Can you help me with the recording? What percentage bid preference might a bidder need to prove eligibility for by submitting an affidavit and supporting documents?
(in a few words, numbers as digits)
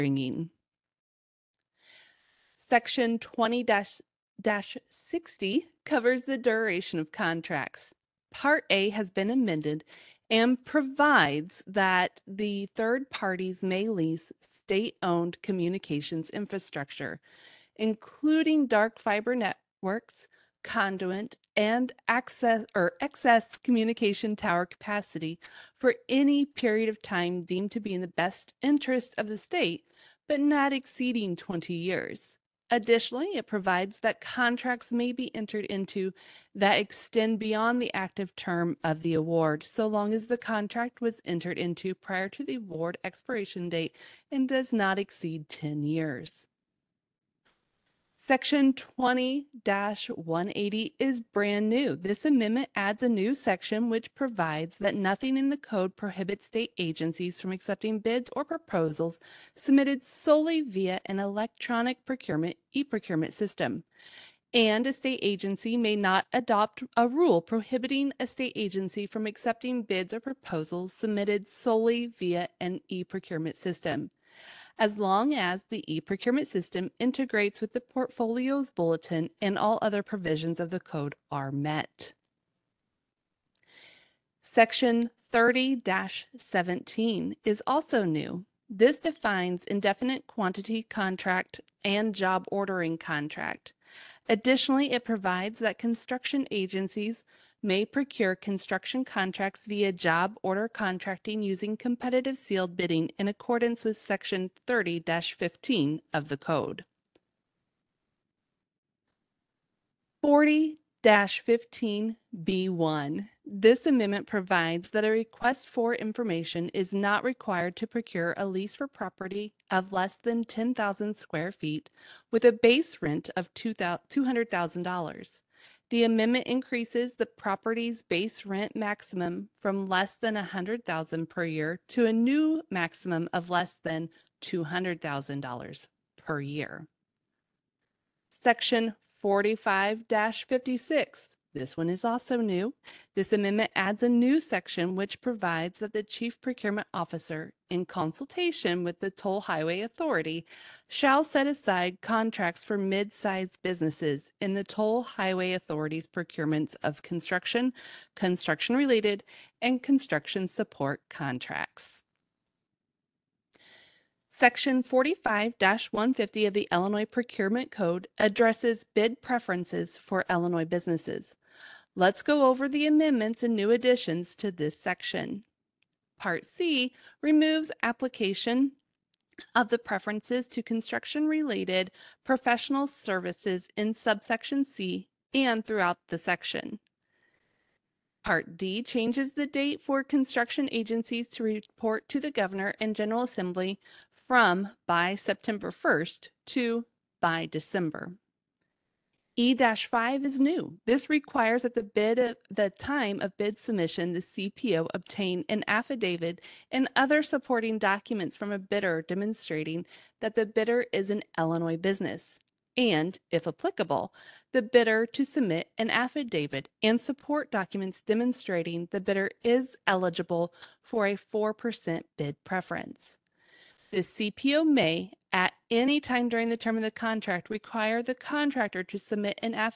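4%.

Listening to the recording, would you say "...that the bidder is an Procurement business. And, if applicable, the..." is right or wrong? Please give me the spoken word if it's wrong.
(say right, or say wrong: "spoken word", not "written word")
wrong: "Illinois", not "Procurement".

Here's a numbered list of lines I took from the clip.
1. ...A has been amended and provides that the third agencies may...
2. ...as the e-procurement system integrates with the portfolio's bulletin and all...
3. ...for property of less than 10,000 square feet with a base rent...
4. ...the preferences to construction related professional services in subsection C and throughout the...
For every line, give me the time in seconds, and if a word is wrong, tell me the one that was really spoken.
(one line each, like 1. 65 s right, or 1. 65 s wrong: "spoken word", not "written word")
1. 8 s wrong: "parties", not "agencies"
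2. 75 s right
3. 118 s right
4. 179 s right.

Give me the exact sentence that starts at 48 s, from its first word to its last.
Section 20 180 is brand new.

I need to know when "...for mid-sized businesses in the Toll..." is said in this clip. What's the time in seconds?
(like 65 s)
152 s.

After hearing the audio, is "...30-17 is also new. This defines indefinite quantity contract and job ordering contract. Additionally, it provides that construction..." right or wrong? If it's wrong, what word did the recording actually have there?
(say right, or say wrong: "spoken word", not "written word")
right.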